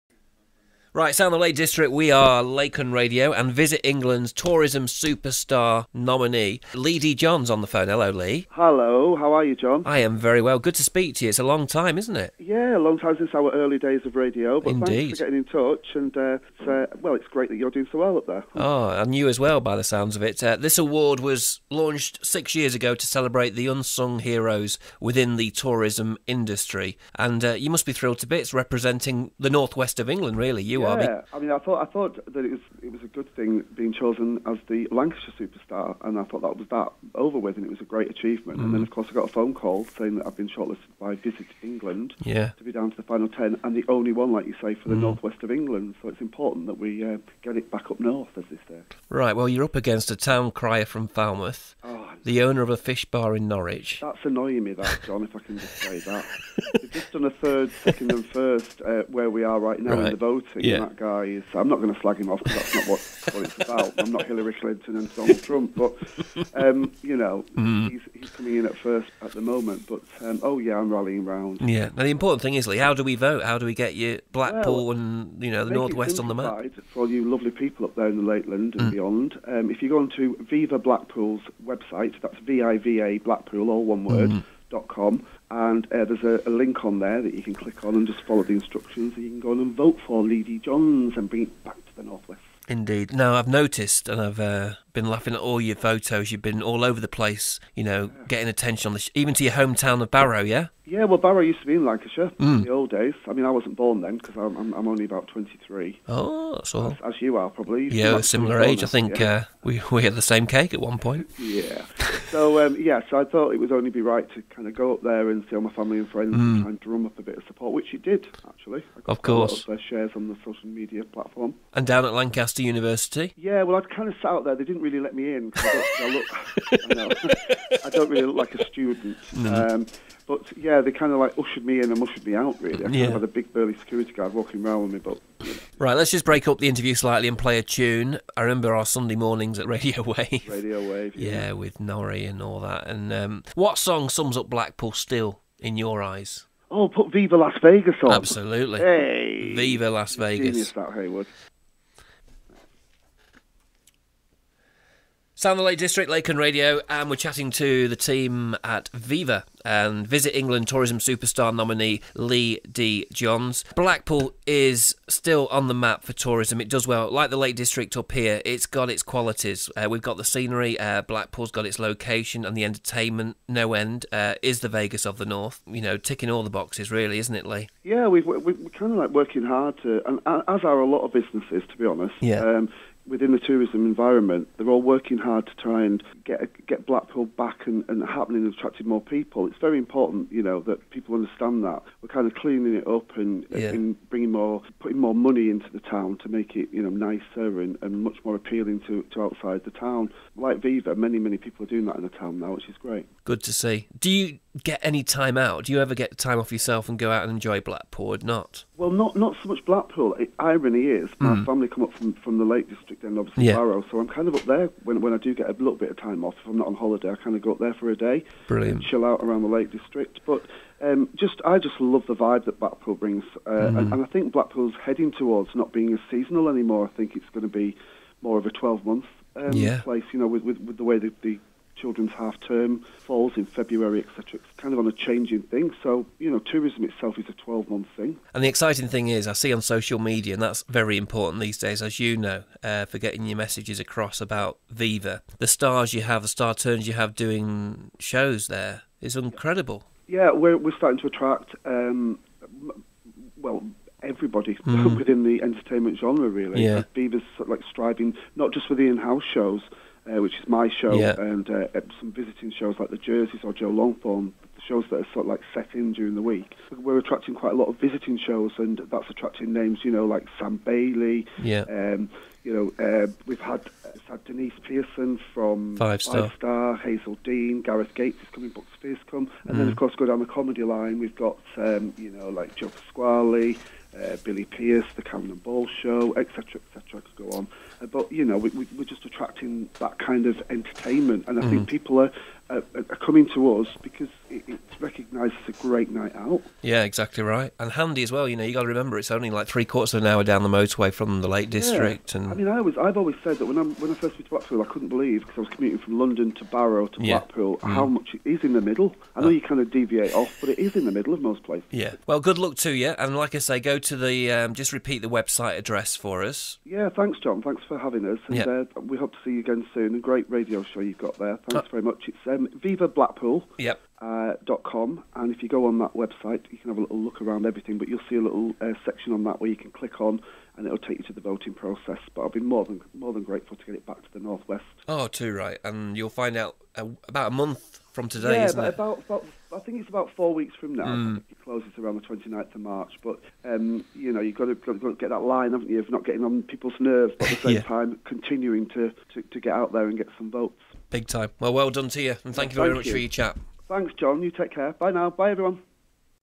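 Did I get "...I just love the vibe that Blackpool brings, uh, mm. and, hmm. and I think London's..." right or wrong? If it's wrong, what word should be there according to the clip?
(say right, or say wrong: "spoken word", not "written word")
wrong: "Blackpool", not "London".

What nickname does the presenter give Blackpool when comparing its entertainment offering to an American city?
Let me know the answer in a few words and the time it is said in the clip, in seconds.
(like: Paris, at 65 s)
The Vegas of the North, at 174 s.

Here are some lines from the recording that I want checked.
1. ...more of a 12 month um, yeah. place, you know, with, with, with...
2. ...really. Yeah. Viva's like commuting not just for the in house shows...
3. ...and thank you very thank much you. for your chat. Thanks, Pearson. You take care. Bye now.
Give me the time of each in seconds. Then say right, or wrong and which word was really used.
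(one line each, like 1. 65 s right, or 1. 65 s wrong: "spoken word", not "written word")
1. 228 s right
2. 256 s wrong: "striving", not "commuting"
3. 352 s wrong: "John", not "Pearson".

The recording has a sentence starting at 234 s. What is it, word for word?
It's kind of on a changing thing.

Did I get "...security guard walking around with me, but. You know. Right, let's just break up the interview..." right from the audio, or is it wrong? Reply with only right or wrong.
right.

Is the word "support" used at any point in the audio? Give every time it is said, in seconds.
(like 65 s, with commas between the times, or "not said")
117 s.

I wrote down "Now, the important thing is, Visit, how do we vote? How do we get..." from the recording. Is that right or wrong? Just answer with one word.
wrong.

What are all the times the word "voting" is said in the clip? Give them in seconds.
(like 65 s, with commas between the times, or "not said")
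60 s, 331 s.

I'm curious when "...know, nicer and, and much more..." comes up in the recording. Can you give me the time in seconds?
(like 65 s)
196 s.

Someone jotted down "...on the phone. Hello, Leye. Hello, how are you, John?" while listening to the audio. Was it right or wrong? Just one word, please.
right.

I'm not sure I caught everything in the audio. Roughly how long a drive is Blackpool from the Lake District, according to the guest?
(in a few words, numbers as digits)
Three quarters of an hour.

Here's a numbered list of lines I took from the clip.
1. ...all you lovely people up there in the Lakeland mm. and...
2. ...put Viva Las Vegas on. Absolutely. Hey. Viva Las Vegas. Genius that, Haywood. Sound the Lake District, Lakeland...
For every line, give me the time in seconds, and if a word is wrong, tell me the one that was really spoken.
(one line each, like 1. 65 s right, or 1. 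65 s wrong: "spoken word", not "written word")
1. 77 s right
2. 146 s right.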